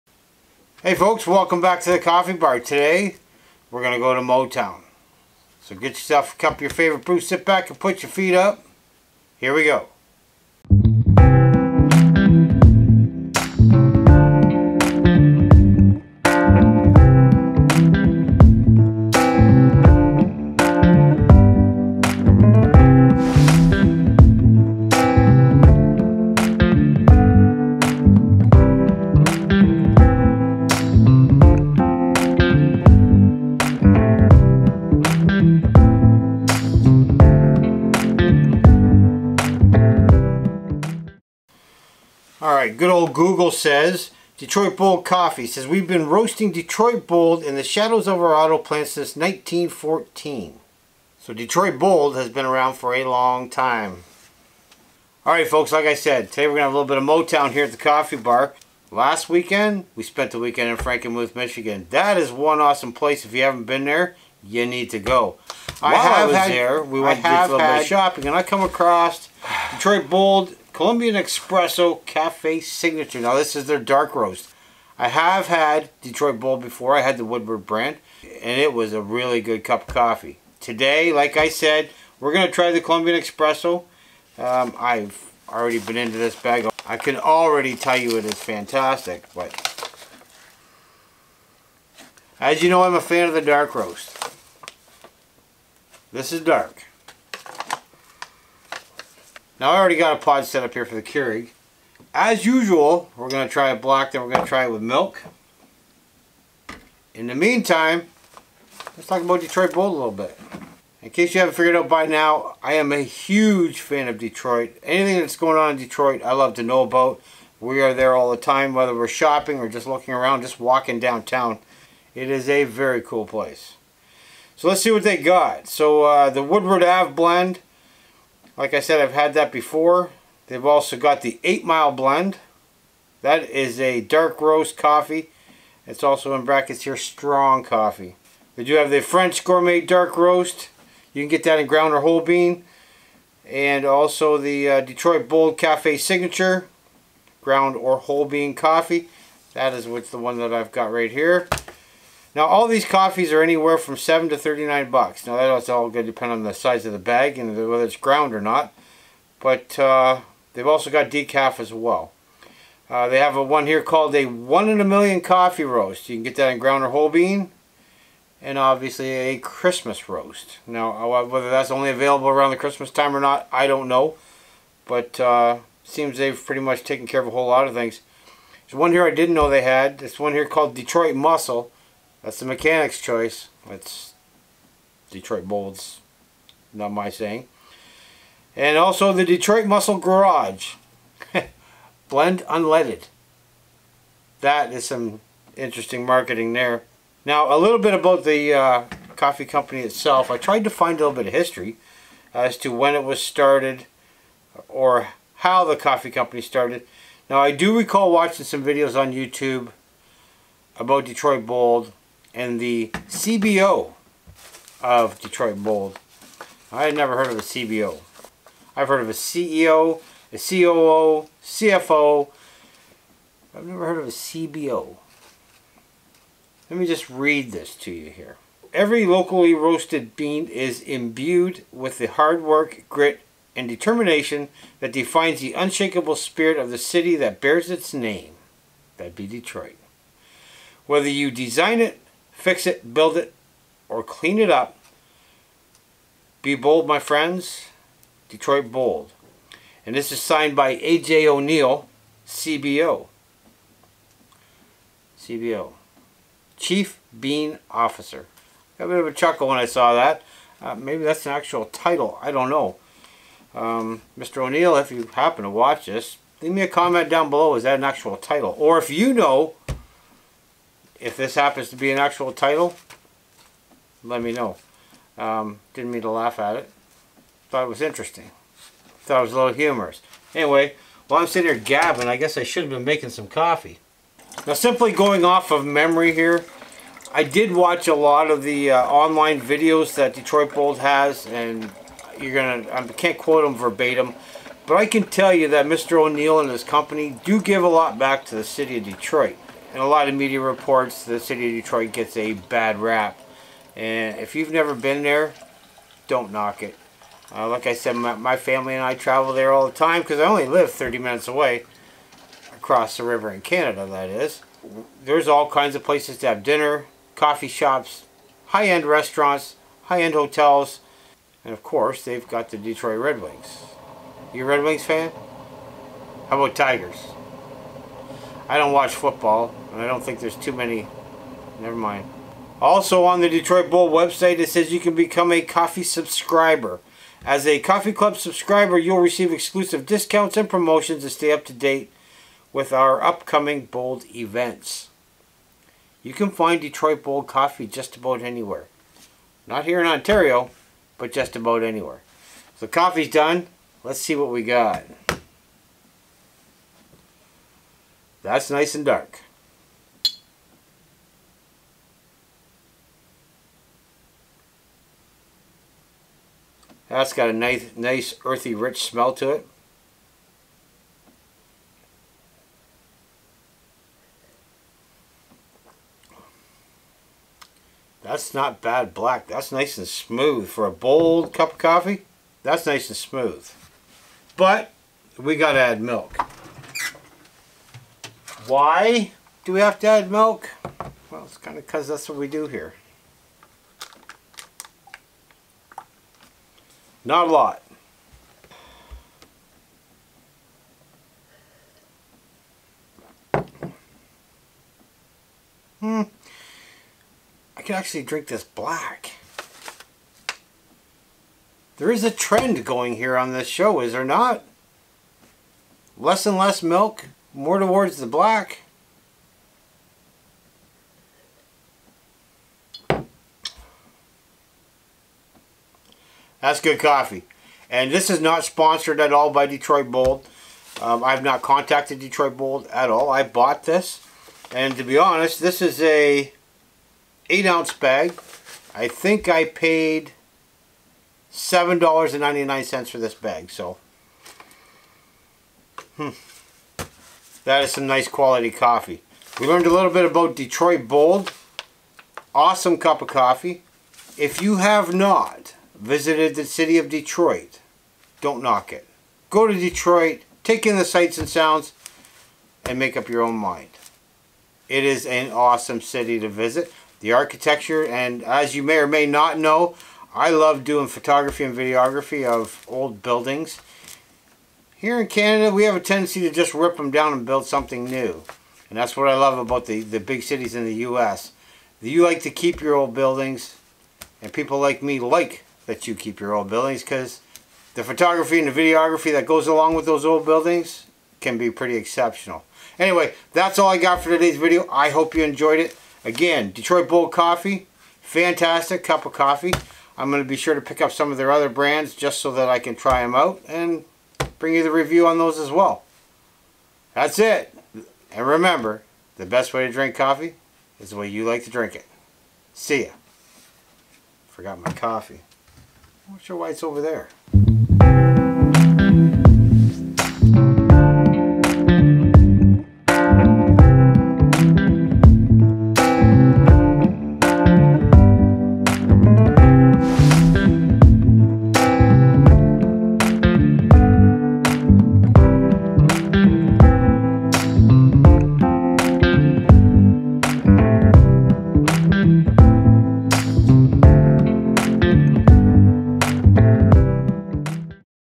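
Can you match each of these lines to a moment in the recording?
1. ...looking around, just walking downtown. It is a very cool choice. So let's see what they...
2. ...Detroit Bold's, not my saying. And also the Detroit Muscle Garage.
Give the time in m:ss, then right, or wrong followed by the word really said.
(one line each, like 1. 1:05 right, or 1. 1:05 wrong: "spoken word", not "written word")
1. 1:59 wrong: "place", not "choice"
2. 3:05 right.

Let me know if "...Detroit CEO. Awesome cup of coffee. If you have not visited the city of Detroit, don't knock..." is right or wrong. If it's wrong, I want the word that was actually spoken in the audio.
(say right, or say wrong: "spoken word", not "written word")
wrong: "Bold", not "CEO".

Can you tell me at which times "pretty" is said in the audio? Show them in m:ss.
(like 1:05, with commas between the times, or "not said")
2:56, 8:11.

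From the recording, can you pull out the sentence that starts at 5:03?
And if you've never been there, don't knock it.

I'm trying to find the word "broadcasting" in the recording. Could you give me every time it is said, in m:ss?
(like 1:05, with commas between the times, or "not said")
not said.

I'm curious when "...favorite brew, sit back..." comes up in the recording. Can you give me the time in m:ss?
0:06.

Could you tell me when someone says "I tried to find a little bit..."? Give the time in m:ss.
3:20.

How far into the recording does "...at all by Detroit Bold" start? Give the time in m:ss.
7:08.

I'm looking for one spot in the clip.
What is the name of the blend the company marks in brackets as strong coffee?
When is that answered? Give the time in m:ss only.
2:11.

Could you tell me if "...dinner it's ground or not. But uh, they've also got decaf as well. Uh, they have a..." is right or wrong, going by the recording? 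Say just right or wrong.
wrong.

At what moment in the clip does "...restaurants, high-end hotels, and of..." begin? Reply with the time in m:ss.
5:18.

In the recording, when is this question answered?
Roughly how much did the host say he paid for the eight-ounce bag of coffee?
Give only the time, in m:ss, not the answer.
7:21.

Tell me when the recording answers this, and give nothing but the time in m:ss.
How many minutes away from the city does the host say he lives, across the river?
5:10.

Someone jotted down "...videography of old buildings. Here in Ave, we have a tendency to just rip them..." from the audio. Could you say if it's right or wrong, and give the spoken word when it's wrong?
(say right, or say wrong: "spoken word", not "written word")
wrong: "Canada", not "Ave".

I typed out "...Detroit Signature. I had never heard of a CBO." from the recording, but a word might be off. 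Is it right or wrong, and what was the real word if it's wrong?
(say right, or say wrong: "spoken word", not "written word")
wrong: "Bold", not "Signature".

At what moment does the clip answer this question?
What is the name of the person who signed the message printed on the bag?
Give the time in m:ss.
4:10.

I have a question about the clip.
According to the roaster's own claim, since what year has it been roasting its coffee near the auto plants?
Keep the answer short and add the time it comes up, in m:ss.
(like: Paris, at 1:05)
1914, at 0:49.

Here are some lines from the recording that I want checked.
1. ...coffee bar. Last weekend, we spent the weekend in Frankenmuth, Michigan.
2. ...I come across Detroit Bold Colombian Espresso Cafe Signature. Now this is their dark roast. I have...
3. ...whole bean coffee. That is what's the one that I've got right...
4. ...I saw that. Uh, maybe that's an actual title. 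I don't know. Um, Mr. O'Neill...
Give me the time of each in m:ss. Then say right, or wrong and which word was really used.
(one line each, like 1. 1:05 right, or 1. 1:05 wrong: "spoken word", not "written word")
1. 0:57 right
2. 1:08 right
3. 2:27 right
4. 4:19 right.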